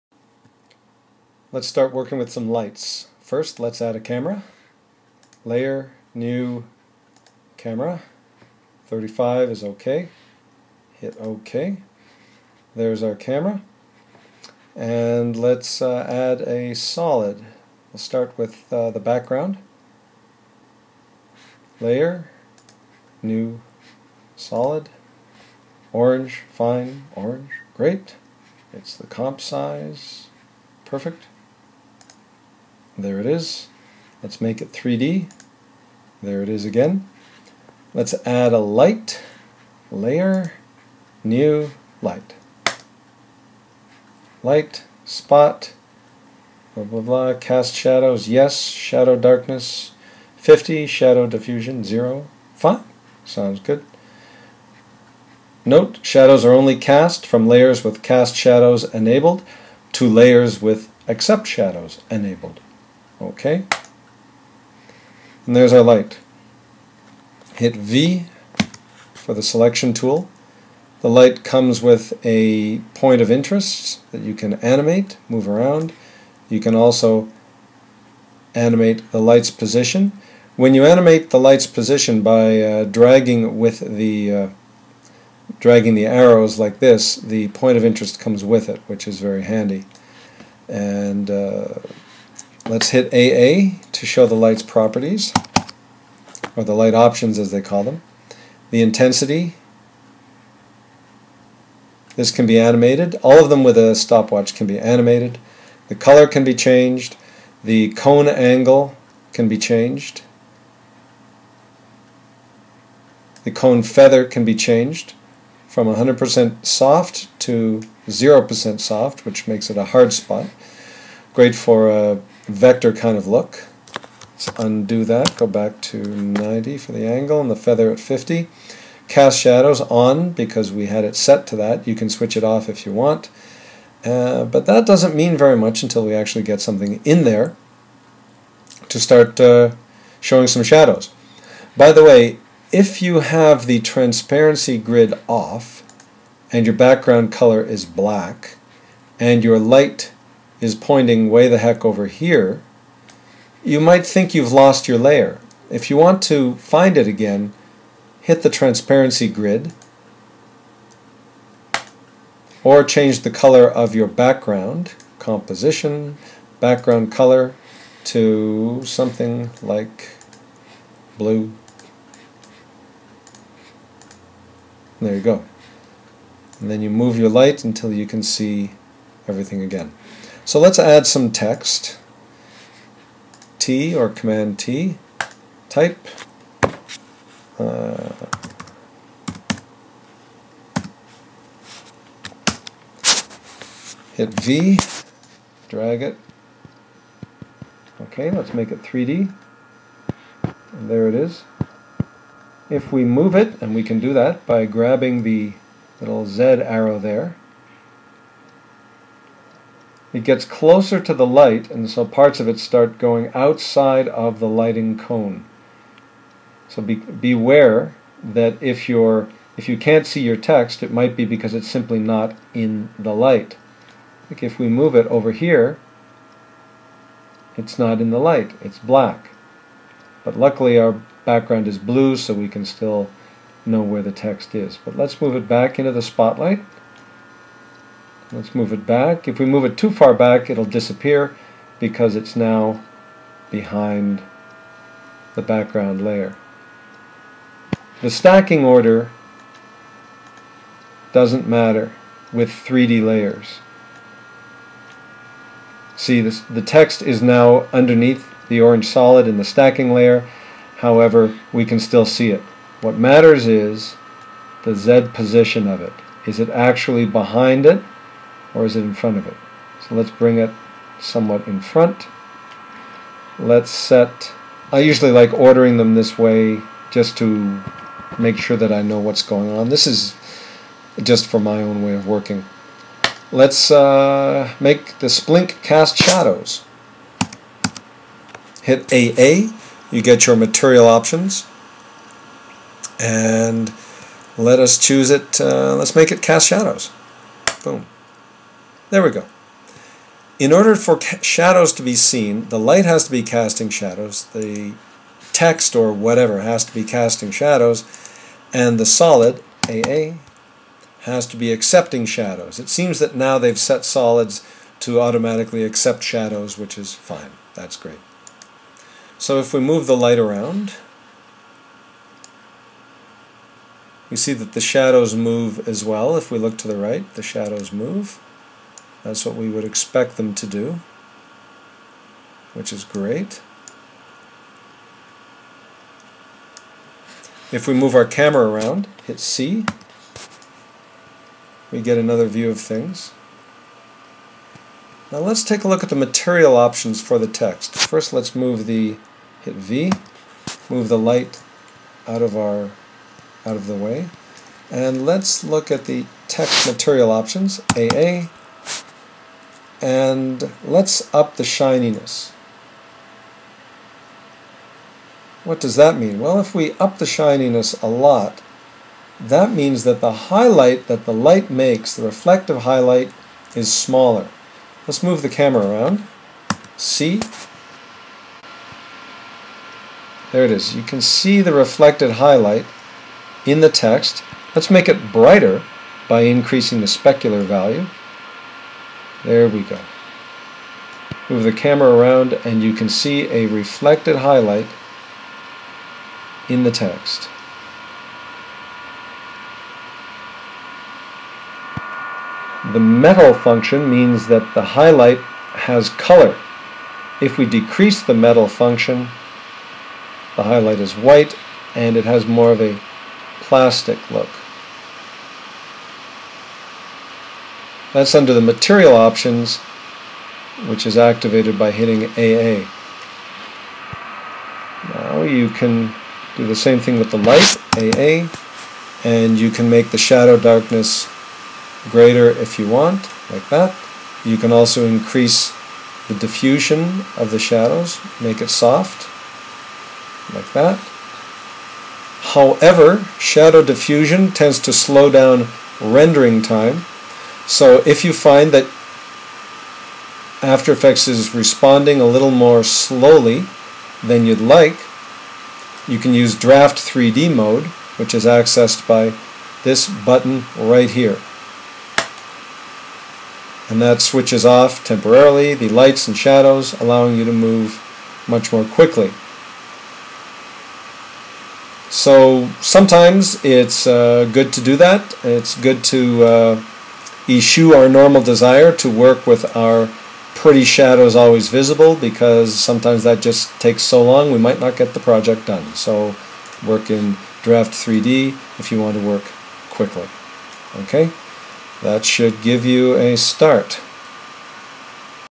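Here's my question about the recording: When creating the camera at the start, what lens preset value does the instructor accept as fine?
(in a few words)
35.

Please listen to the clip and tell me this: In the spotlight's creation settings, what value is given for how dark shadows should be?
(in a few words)
50.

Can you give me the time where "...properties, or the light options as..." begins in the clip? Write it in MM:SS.
01:34.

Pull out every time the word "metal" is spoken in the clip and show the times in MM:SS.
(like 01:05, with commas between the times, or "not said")
06:42, 06:48.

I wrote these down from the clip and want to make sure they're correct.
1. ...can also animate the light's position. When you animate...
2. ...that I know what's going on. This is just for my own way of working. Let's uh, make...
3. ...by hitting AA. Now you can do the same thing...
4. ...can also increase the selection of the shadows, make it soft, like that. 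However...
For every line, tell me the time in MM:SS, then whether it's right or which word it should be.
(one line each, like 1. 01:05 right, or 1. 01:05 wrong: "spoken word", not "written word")
1. 01:16 right
2. 04:38 right
3. 07:01 right
4. 07:14 wrong: "diffusion", not "selection".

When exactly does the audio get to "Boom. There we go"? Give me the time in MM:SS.
04:57.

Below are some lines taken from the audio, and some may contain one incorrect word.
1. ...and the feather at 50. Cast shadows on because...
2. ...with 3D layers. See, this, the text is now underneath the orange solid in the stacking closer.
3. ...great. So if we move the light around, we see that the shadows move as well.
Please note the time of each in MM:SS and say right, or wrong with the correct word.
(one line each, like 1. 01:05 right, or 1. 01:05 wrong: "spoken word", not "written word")
1. 02:07 right
2. 04:12 wrong: "layer", not "closer"
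3. 05:17 right.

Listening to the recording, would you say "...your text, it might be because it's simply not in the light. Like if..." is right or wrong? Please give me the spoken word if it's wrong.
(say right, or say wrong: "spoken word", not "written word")
right.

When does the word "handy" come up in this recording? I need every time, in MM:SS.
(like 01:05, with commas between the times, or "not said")
01:29.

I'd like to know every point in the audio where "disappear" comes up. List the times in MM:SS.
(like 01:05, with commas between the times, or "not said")
04:00.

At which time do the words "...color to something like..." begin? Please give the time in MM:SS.
02:47.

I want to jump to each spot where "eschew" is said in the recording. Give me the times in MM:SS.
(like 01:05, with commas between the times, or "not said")
07:57.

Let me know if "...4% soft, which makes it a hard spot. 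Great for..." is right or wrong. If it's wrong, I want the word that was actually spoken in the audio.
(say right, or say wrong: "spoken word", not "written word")
wrong: "0", not "4".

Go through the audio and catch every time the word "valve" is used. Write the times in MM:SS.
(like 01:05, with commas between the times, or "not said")
not said.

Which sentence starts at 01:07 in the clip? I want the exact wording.
Hit V for the selection tool.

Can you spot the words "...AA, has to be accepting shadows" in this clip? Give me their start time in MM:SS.
05:09.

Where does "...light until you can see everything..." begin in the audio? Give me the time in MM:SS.
02:57.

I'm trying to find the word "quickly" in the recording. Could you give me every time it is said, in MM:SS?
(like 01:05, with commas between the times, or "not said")
07:48, 08:09.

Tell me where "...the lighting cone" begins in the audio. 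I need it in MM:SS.
03:34.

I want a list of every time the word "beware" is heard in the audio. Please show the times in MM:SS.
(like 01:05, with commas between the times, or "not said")
03:36.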